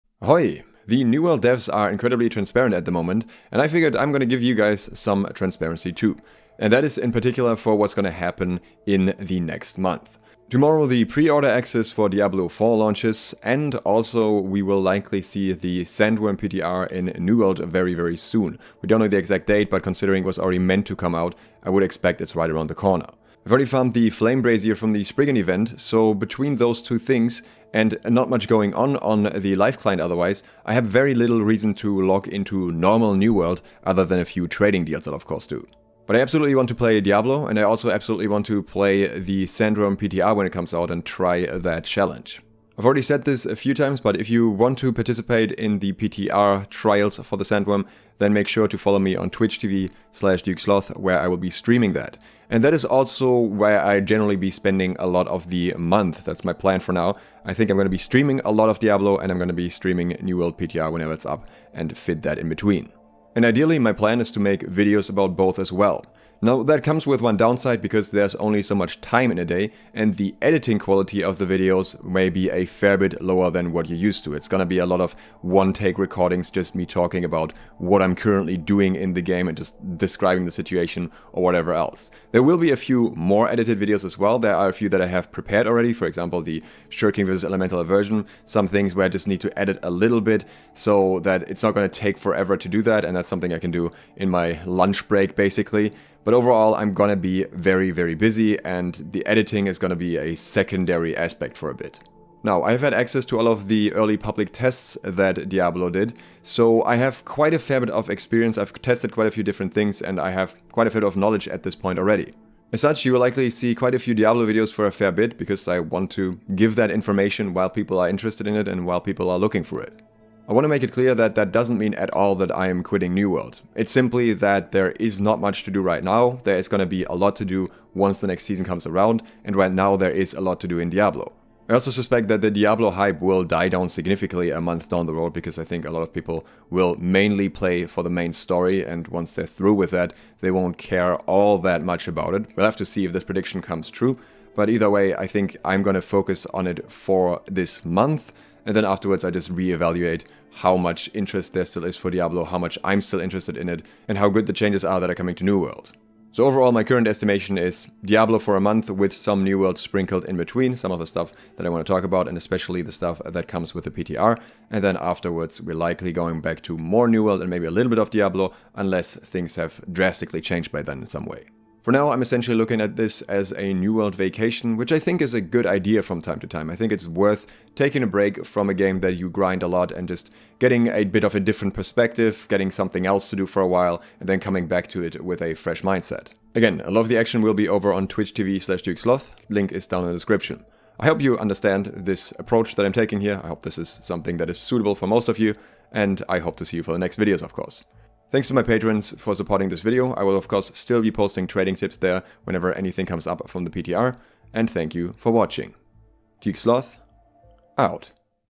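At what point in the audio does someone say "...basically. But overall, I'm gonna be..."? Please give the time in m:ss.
1:35.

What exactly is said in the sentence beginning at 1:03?
And ideally, my plan is to make videos about both as well.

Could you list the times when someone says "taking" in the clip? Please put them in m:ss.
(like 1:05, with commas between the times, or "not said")
2:57, 3:12.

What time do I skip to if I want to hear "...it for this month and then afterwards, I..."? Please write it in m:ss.
2:26.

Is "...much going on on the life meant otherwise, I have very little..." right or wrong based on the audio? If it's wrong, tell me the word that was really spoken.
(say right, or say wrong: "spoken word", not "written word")
wrong: "client", not "meant".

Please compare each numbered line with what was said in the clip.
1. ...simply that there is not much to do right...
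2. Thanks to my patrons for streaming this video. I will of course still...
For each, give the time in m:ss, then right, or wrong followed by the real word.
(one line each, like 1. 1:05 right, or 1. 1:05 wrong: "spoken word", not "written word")
1. 2:03 right
2. 3:18 wrong: "supporting", not "streaming".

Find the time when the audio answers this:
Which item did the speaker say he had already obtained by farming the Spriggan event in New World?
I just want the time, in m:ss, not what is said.
0:24.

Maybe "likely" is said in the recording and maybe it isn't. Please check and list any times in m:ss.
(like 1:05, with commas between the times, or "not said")
0:14, 1:53, 2:45.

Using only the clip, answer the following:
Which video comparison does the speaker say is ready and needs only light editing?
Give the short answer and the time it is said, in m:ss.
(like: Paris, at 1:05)
Shirking versus Elemental, at 1:26.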